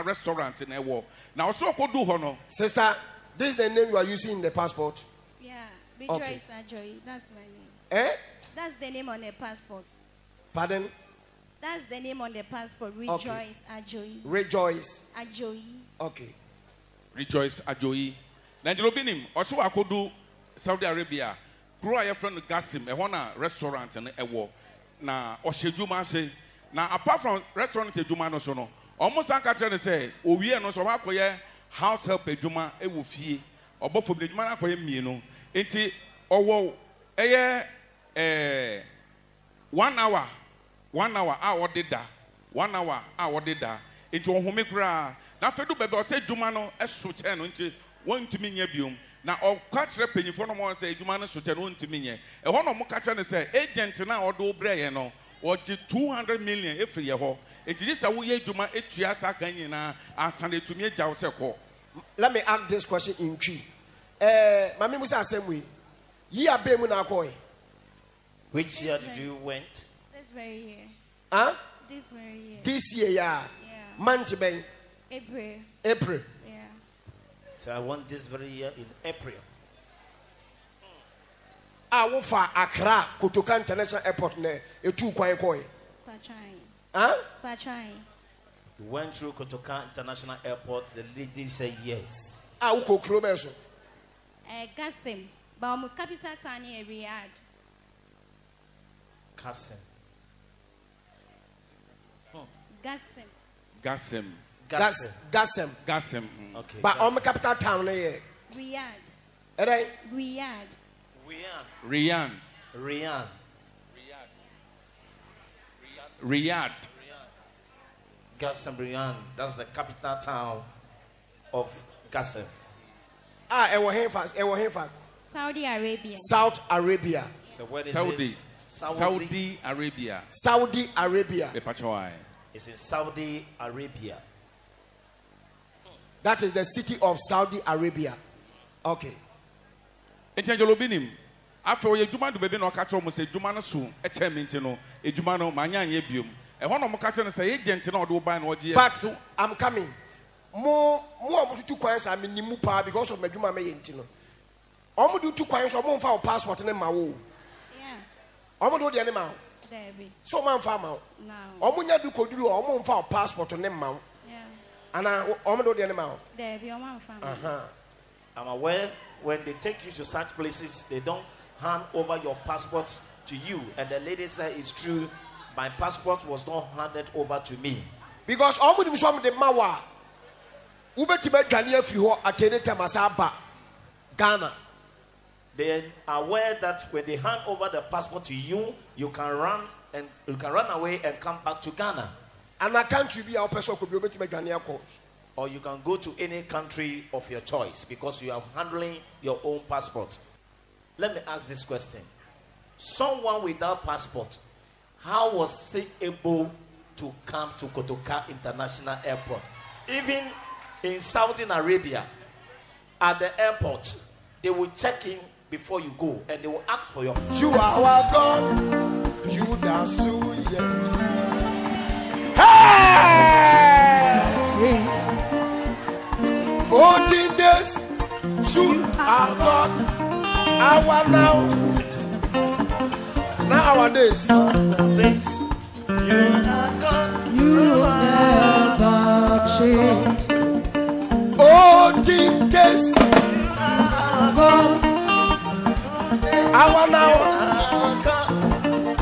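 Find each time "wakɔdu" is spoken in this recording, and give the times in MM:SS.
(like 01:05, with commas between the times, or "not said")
00:19.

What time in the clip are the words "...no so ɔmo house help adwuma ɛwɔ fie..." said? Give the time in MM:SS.
00:30.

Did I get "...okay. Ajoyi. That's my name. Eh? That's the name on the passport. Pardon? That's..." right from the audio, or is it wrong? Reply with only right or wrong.
right.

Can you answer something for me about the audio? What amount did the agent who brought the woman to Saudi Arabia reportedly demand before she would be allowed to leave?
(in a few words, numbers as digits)
200 million.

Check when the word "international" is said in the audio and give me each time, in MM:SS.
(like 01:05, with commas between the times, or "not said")
01:23, 01:29, 03:28.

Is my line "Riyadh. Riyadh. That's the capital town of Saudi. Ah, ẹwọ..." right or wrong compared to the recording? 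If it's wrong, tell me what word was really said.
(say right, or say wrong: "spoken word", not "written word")
wrong: "Gasim", not "Saudi".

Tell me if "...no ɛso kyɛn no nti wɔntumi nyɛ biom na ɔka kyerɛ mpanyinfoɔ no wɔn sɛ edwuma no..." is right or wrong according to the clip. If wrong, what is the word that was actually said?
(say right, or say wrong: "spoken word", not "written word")
right.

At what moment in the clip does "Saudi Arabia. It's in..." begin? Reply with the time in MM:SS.
02:10.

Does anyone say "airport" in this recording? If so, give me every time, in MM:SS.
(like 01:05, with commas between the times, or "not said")
01:24, 01:30, 03:29, 03:33.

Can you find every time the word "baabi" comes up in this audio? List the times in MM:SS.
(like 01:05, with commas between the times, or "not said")
00:45, 02:22.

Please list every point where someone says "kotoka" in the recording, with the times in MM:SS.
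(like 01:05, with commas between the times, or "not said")
01:23, 01:29, 03:27.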